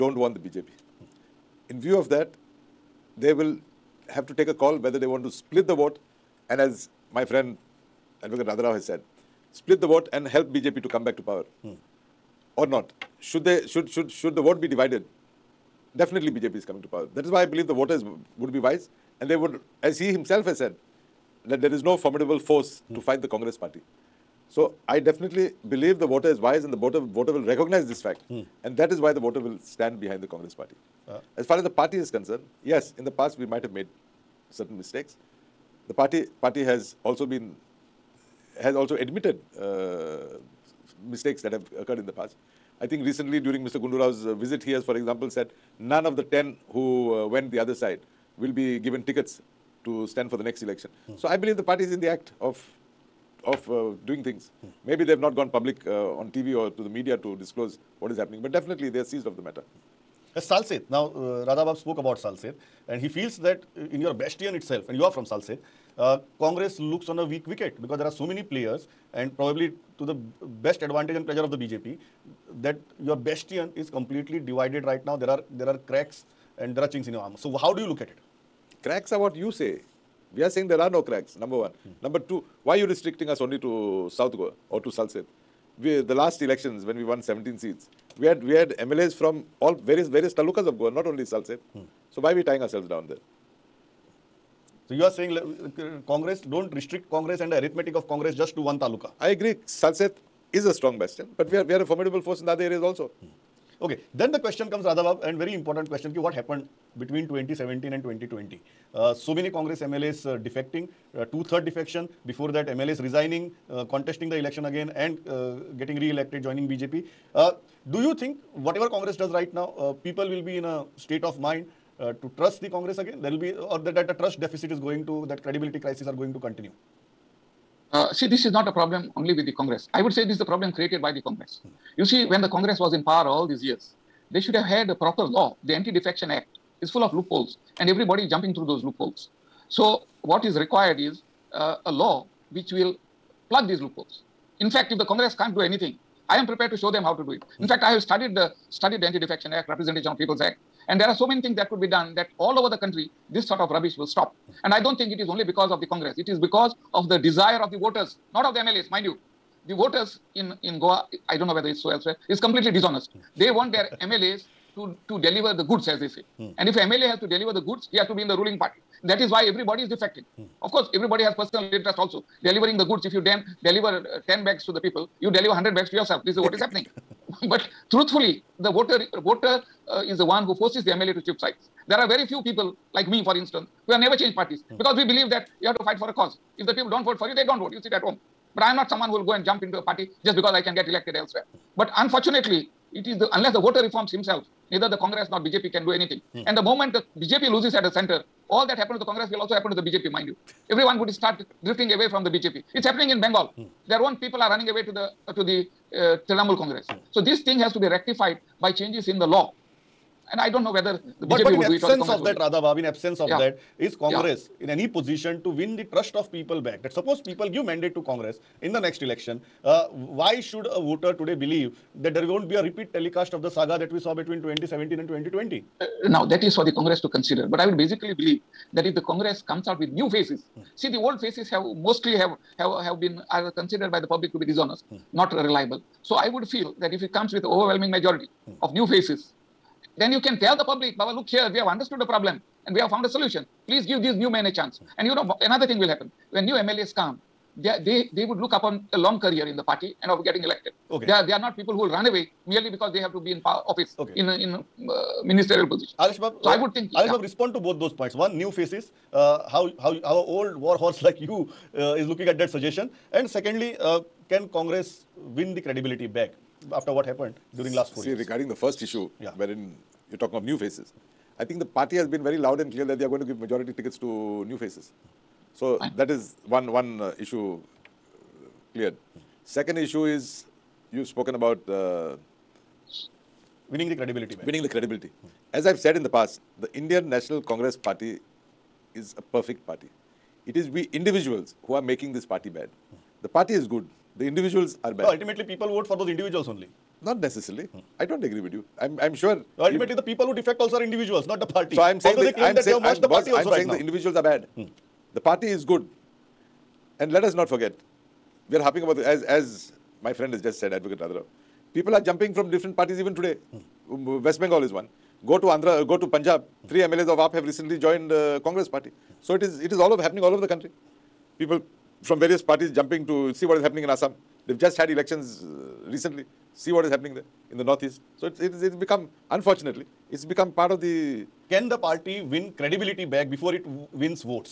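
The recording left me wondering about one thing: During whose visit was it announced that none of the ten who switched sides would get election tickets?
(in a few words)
Mr. Gundurao.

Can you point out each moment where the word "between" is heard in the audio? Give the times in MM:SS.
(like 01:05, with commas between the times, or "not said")
01:46, 03:44.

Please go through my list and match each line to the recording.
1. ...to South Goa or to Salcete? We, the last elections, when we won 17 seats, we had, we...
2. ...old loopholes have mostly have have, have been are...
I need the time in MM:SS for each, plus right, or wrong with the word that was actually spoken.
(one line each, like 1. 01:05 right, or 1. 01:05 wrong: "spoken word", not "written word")
1. 01:23 right
2. 03:50 wrong: "faces", not "loopholes".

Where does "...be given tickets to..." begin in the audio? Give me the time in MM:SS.
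00:48.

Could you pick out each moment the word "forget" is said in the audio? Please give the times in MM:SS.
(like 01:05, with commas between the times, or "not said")
05:07.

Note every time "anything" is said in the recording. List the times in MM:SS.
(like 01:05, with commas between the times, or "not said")
02:25, 03:15.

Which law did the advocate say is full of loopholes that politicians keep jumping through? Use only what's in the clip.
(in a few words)
Anti Defection Act.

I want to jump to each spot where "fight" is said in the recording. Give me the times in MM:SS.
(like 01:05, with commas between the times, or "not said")
00:23, 03:05.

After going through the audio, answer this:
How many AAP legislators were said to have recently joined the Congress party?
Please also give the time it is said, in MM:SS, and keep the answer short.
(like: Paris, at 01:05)
3, at 05:16.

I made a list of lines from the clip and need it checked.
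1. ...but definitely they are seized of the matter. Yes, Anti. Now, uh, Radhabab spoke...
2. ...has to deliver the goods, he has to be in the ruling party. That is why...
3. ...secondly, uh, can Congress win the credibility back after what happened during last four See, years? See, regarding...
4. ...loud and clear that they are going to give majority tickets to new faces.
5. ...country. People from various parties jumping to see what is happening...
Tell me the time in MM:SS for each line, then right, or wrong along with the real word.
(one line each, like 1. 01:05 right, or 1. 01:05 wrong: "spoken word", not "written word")
1. 00:58 wrong: "Salcete", not "Anti"
2. 02:47 right
3. 04:23 right
4. 04:32 right
5. 05:20 right.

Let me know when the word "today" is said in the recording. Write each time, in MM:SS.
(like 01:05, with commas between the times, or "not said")
03:41, 05:13.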